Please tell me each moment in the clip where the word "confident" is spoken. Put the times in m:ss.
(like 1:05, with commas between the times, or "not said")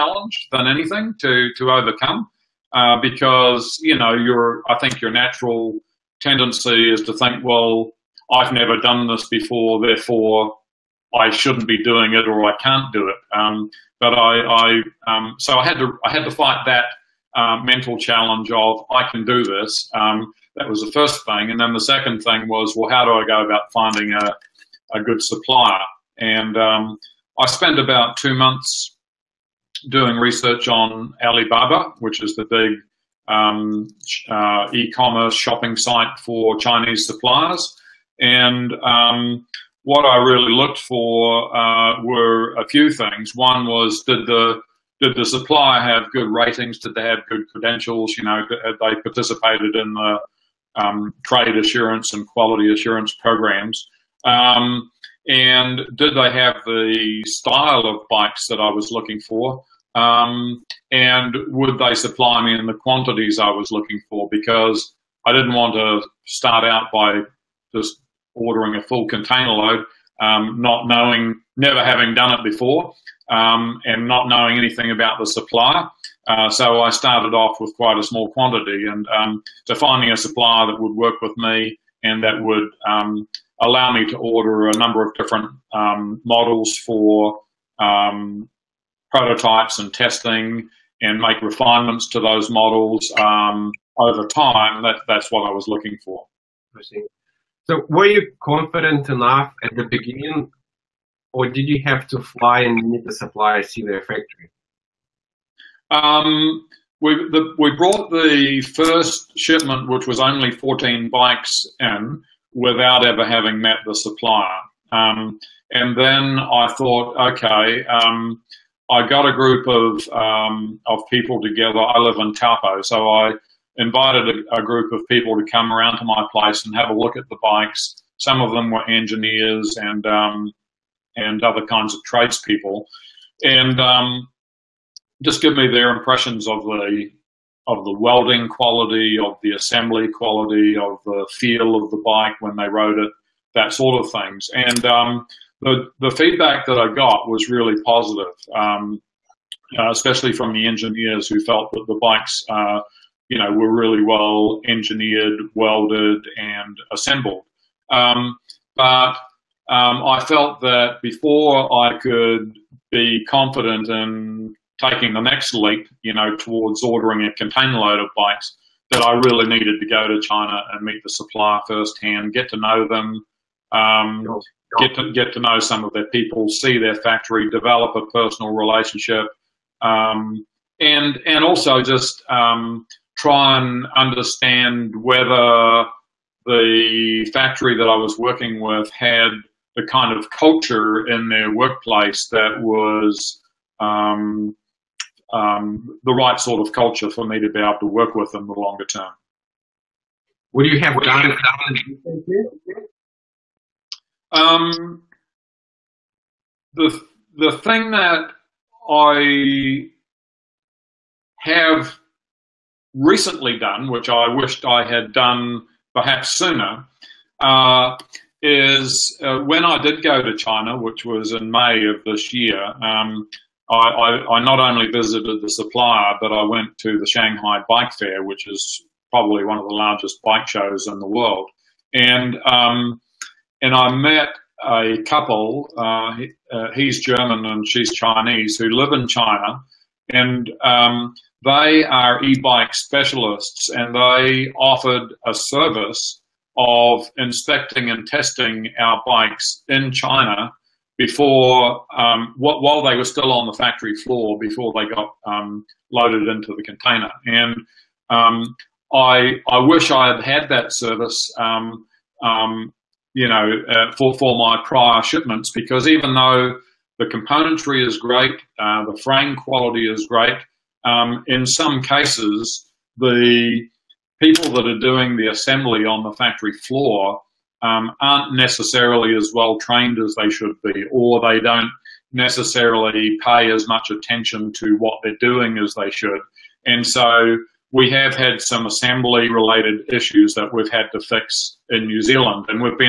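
1:38, 2:43.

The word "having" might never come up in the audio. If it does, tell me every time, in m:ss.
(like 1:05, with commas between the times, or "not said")
1:11, 1:53.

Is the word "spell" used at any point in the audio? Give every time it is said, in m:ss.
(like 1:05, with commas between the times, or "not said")
not said.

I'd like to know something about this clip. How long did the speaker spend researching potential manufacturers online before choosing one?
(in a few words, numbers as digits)
2 months.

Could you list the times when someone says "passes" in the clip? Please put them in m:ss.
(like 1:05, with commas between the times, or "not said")
not said.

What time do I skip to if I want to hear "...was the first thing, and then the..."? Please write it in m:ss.
0:20.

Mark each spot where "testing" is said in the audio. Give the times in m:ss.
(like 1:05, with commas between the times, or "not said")
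1:29, 4:08.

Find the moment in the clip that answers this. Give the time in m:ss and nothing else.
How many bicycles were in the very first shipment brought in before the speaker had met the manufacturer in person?
1:50.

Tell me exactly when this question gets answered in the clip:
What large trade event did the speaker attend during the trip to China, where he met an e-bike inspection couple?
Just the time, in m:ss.
3:47.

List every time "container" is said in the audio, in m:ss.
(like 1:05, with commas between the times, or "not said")
1:09, 2:47, 4:16.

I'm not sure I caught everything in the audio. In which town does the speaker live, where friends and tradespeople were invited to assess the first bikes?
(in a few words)
Taupo.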